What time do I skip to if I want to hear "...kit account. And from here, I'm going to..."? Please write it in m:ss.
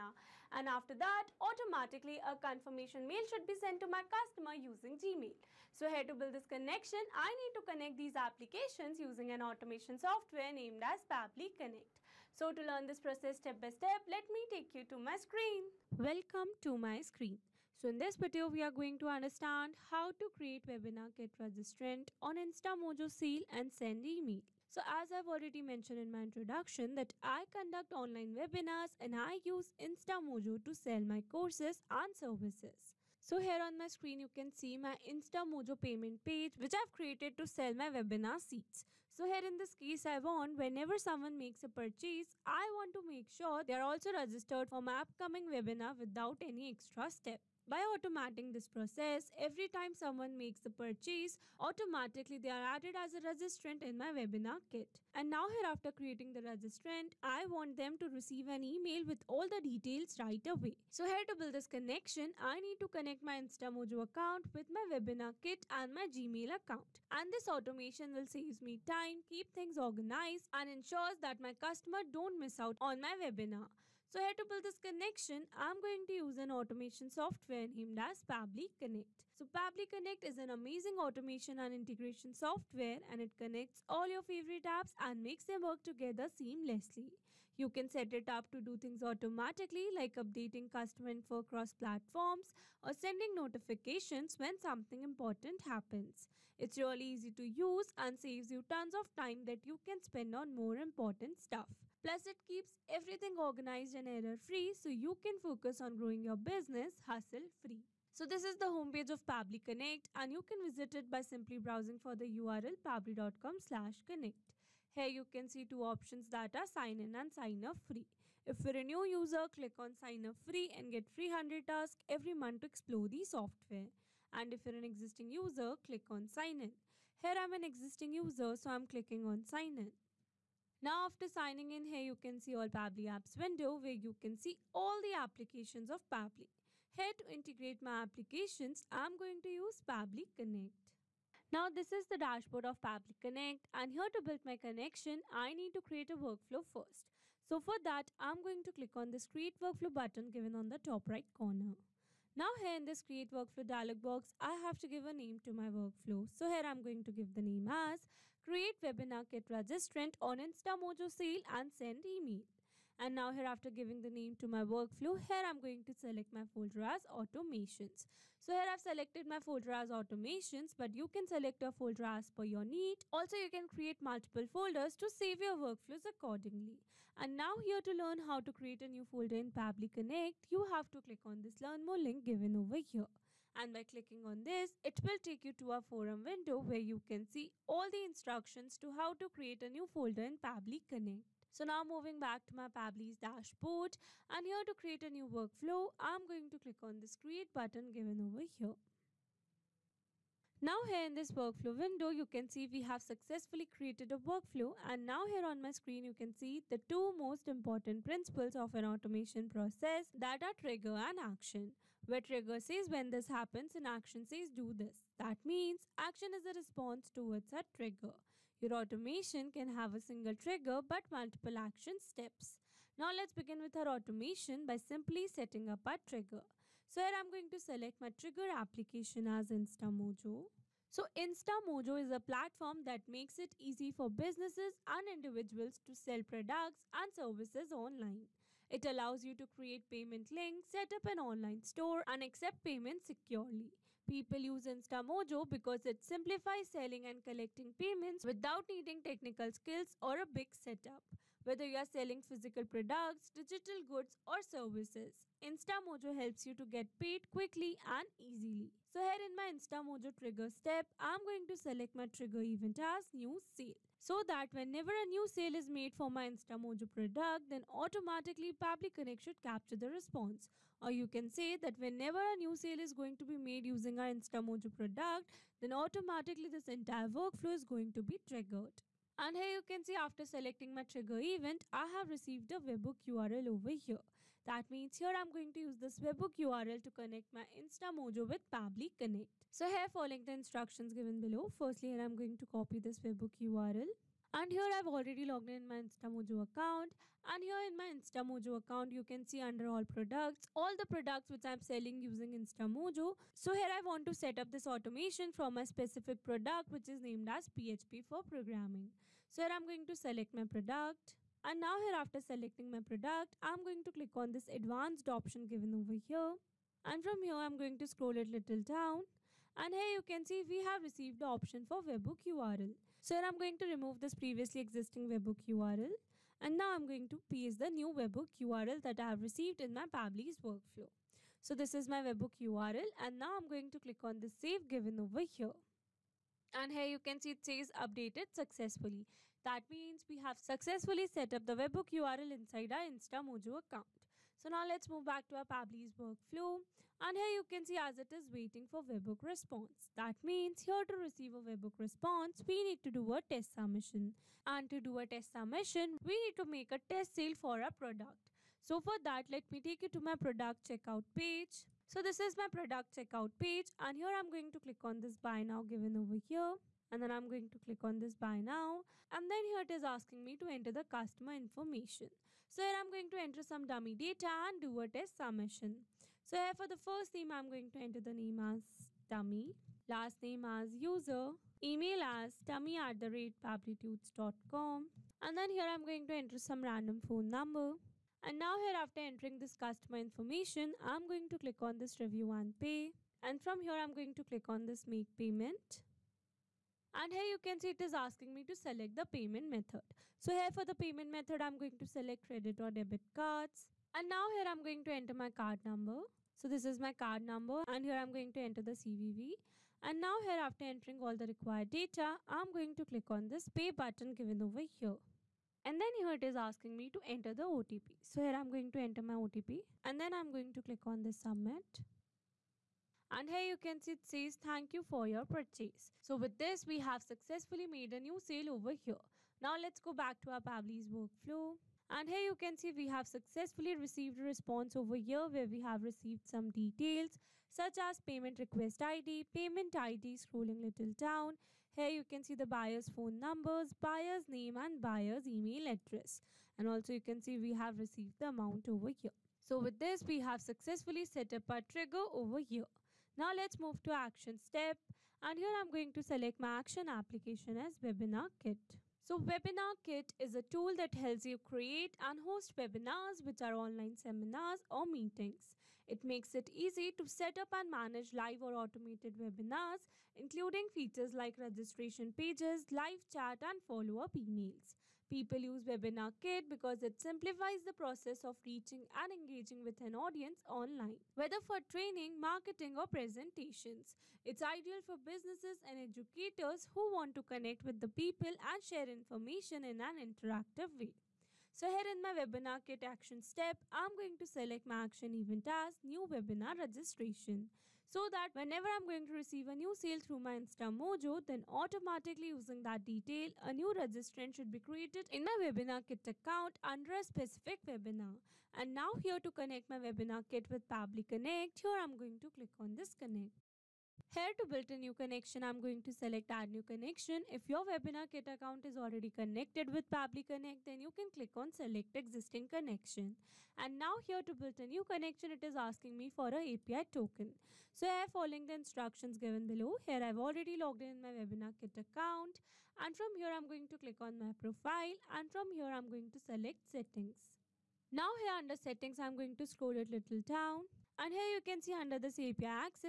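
8:51.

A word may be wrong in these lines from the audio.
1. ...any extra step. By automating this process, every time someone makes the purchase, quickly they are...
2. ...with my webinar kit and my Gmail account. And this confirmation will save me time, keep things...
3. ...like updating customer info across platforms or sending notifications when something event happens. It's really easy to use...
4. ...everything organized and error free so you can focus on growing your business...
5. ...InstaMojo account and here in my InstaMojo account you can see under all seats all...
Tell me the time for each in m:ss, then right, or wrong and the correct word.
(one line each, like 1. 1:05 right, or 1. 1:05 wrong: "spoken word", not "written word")
1. 0:46 wrong: "automatically", not "quickly"
2. 1:04 wrong: "automation", not "confirmation"
3. 1:29 wrong: "important", not "event"
4. 1:42 right
5. 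4:55 wrong: "products", not "seats".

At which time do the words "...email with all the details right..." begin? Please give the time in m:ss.
0:58.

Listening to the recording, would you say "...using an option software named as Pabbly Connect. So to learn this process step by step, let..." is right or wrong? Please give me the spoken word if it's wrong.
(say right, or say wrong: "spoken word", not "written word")
wrong: "automation", not "option".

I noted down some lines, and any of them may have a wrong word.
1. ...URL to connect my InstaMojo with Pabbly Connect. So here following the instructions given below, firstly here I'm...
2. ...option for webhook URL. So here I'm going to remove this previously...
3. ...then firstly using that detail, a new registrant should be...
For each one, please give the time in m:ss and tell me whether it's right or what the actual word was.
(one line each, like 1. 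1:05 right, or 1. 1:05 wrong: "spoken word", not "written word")
1. 4:46 right
2. 5:21 right
3. 8:21 wrong: "automatically", not "firstly".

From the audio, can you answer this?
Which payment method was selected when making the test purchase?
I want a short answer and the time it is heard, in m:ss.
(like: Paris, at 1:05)
credit or debit cards, at 6:42.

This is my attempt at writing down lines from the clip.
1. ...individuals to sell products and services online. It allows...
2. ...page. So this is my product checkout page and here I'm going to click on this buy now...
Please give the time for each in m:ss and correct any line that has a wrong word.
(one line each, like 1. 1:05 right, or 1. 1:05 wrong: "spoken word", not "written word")
1. 3:55 right
2. 6:01 right.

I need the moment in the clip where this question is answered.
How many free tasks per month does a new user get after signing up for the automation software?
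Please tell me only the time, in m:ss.
2:01.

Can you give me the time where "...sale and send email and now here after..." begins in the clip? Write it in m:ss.
2:41.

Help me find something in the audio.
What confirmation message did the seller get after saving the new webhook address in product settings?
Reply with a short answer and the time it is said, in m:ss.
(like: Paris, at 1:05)
updated successfully, at 5:37.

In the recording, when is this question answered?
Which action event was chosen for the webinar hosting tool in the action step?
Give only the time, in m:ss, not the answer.
8:15.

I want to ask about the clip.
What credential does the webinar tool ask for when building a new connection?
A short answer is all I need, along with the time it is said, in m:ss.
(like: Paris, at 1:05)
API token, at 8:46.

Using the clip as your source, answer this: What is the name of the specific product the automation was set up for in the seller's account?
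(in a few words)
PHP for programming.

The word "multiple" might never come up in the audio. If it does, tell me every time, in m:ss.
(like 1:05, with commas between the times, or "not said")
2:54, 3:41.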